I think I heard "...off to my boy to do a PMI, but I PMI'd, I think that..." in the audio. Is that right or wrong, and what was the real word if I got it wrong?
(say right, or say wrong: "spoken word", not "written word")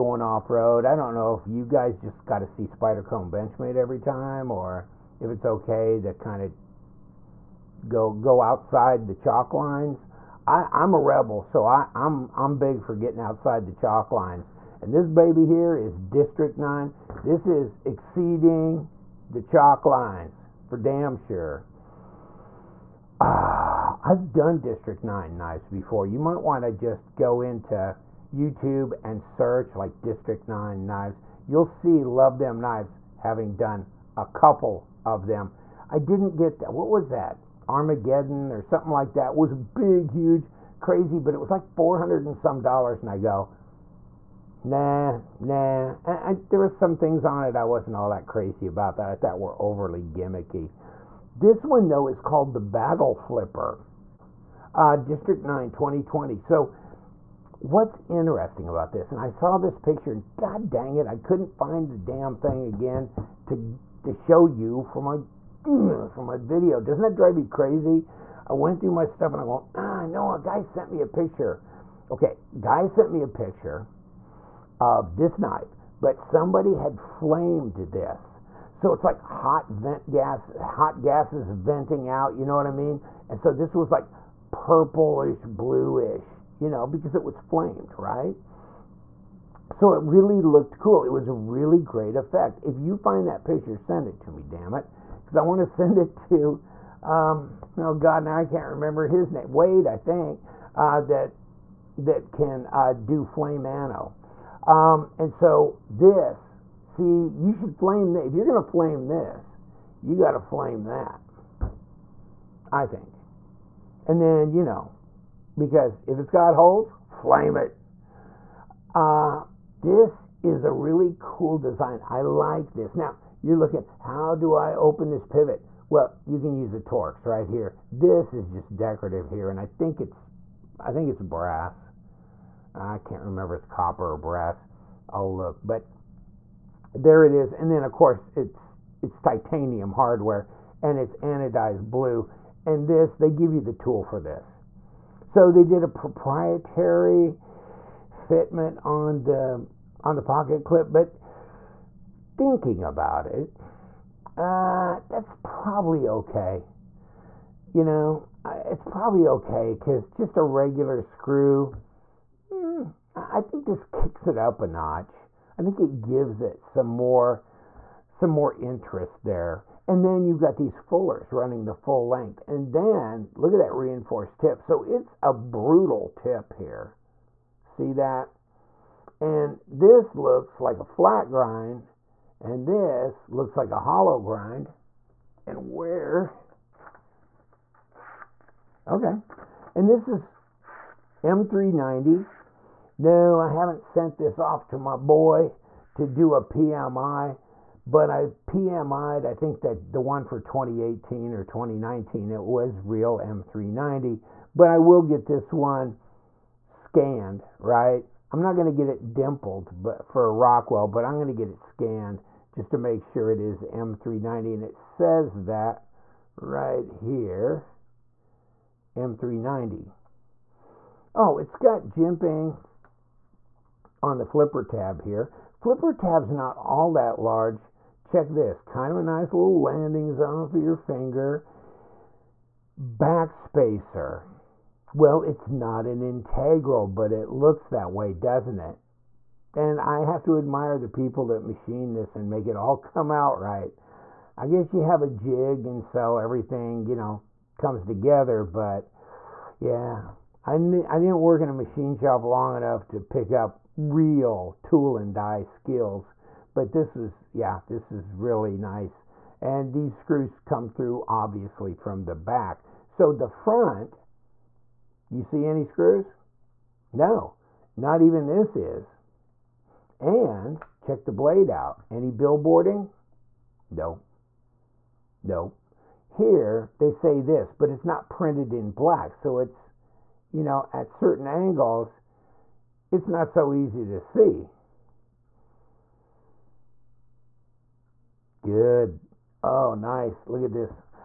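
right.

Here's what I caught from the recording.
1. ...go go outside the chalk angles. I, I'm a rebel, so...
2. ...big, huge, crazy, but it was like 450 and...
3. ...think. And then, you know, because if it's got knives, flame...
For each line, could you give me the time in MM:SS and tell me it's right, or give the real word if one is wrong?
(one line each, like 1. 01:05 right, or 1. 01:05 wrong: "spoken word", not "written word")
1. 00:07 wrong: "lines", not "angles"
2. 00:39 wrong: "400", not "450"
3. 01:52 wrong: "holes", not "knives".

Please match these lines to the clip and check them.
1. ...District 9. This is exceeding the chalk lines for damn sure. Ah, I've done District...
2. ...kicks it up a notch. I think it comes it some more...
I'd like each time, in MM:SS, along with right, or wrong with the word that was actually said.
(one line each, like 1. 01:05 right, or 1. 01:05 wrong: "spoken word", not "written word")
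1. 00:15 right
2. 02:43 wrong: "gives", not "comes".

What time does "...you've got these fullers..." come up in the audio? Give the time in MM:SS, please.
02:50.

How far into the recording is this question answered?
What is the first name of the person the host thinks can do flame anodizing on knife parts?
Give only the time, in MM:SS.
01:39.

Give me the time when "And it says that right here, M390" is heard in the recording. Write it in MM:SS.
03:34.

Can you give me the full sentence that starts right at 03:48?
Check this, kind of a nice little landing zone for your finger.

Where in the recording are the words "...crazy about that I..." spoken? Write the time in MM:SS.
00:48.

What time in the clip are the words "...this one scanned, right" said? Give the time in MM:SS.
03:25.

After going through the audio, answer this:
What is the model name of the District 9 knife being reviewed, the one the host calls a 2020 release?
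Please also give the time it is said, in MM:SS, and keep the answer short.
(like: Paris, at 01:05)
Battle Flipper, at 00:52.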